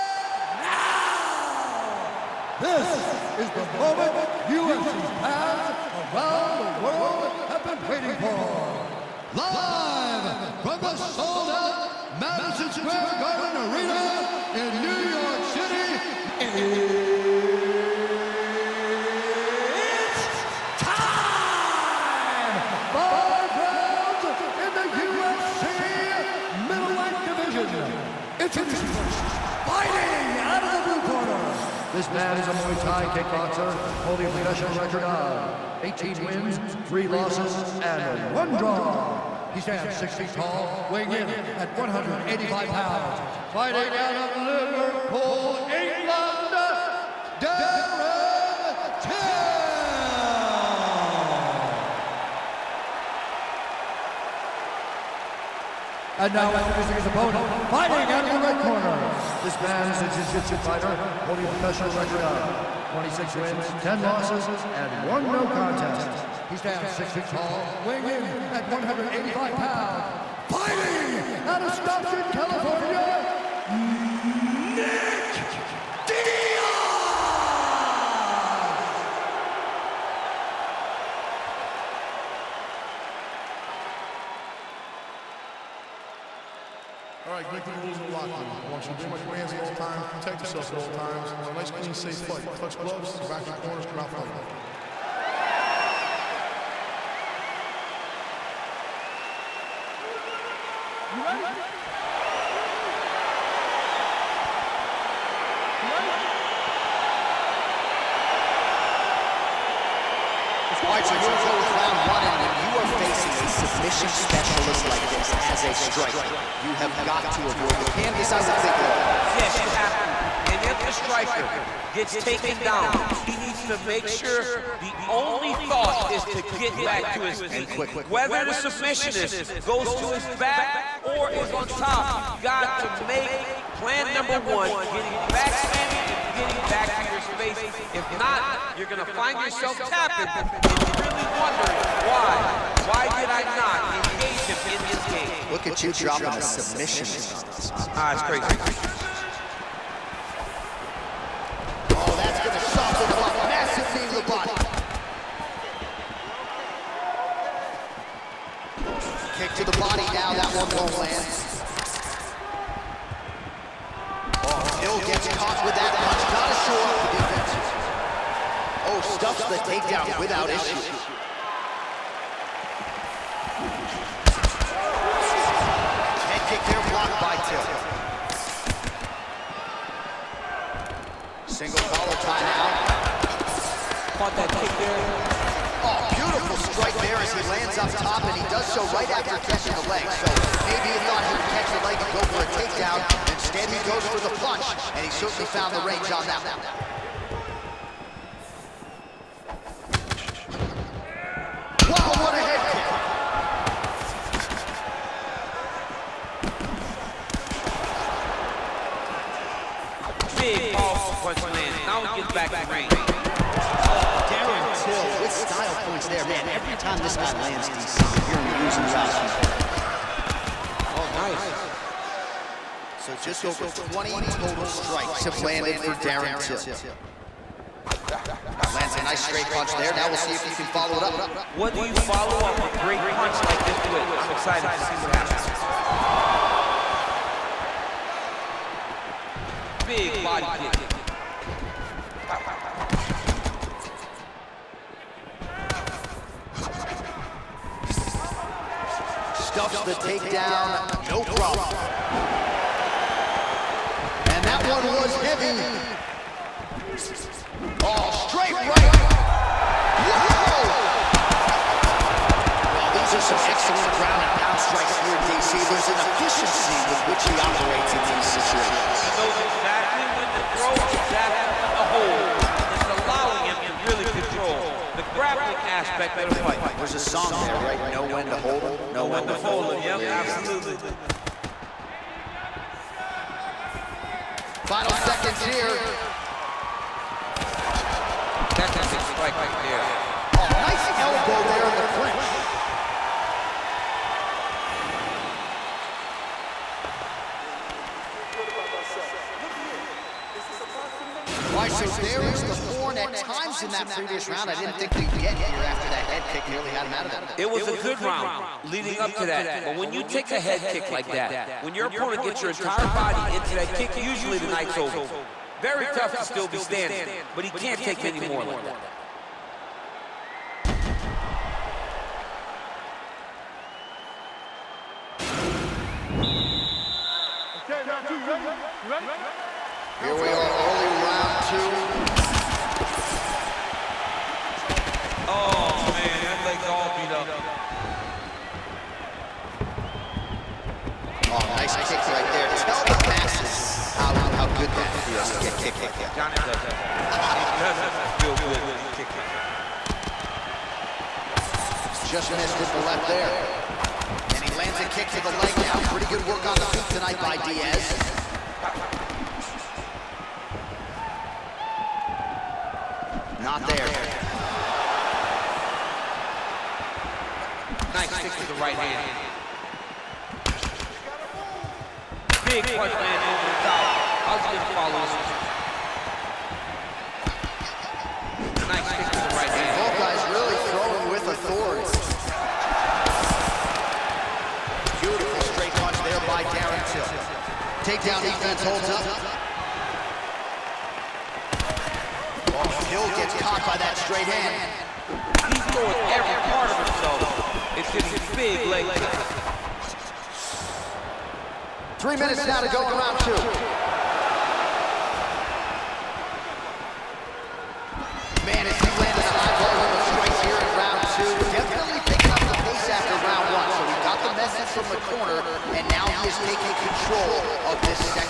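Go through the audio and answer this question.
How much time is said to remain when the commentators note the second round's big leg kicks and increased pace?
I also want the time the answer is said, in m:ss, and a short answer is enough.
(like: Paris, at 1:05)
3 minutes, at 6:42.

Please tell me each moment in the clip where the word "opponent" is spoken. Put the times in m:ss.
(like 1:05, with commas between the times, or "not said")
0:57, 5:11.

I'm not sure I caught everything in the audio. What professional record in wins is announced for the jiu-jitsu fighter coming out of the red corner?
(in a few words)
26.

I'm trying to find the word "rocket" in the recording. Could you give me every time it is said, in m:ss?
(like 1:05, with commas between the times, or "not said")
not said.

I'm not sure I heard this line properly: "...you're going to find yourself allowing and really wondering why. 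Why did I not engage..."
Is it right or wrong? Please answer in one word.
wrong.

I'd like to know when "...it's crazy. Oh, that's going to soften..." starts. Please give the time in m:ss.
2:28.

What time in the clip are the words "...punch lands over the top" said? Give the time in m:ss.
6:12.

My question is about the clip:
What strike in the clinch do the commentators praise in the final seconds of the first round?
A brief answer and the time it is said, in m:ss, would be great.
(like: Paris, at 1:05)
Elbow, at 4:50.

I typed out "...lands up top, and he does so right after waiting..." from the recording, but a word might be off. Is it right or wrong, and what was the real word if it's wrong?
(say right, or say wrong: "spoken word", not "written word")
wrong: "catching", not "waiting".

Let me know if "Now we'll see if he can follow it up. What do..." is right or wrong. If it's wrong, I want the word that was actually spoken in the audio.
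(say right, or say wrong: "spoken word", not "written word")
right.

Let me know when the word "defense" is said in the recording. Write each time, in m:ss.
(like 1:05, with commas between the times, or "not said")
2:47, 6:28.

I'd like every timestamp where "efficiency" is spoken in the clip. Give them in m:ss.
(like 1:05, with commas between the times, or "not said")
4:26.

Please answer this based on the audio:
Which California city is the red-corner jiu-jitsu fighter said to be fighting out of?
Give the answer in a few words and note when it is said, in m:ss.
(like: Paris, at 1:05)
Stockton, at 1:11.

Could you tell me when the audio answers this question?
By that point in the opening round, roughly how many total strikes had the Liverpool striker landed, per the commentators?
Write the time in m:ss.
3:43.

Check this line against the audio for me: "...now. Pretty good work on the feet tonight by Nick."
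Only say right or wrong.
wrong.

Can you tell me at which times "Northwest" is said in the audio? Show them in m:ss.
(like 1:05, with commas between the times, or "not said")
not said.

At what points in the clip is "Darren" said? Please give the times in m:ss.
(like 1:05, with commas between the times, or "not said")
0:47, 3:34, 3:45, 6:26.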